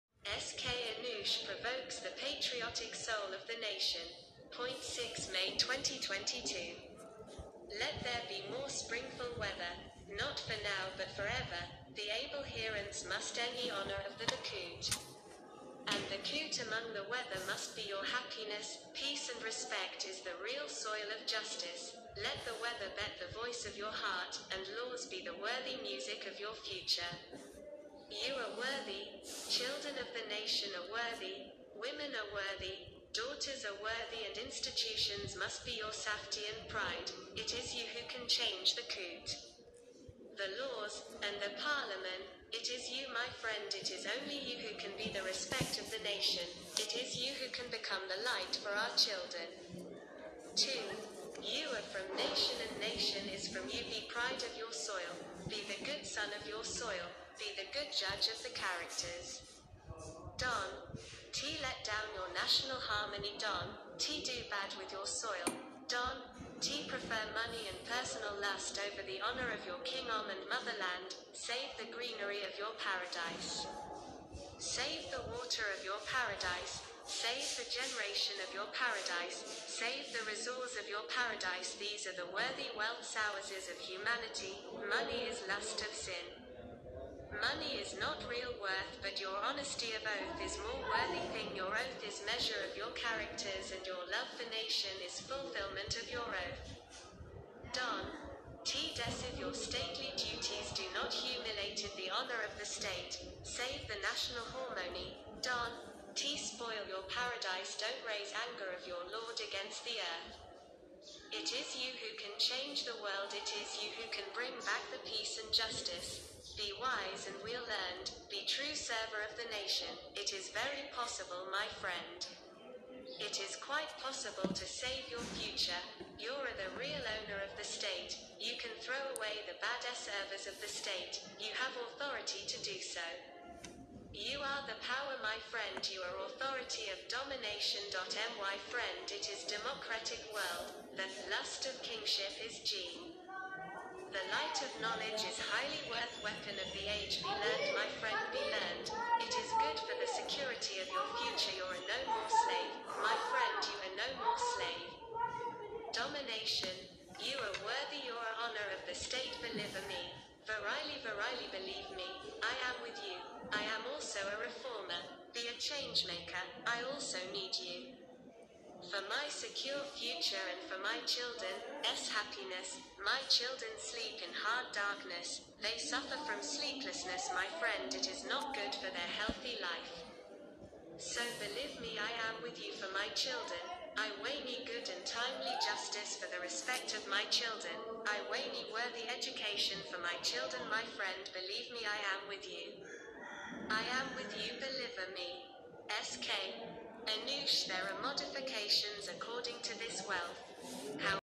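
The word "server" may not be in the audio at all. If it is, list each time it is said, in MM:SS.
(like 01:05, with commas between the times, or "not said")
01:58, 02:09.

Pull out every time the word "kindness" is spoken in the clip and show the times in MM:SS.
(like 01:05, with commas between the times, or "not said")
not said.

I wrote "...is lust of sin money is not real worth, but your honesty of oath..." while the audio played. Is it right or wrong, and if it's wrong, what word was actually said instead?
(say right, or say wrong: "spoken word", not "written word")
right.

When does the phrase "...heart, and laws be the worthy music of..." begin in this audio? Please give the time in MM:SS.
00:23.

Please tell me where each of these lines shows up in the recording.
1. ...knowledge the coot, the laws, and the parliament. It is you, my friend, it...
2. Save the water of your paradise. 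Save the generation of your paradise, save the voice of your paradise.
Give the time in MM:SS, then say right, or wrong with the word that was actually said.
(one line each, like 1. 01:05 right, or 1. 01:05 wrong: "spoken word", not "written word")
1. 00:38 wrong: "change", not "knowledge"
2. 01:14 wrong: "resource", not "voice".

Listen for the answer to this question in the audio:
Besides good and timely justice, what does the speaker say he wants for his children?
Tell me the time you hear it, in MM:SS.
03:08.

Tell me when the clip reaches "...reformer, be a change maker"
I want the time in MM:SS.
02:44.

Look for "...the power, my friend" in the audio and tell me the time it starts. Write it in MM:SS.
02:14.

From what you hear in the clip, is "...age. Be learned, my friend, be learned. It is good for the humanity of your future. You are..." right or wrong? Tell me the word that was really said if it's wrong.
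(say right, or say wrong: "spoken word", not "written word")
wrong: "security", not "humanity".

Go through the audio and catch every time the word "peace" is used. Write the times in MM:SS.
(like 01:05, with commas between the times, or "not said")
00:18, 01:55.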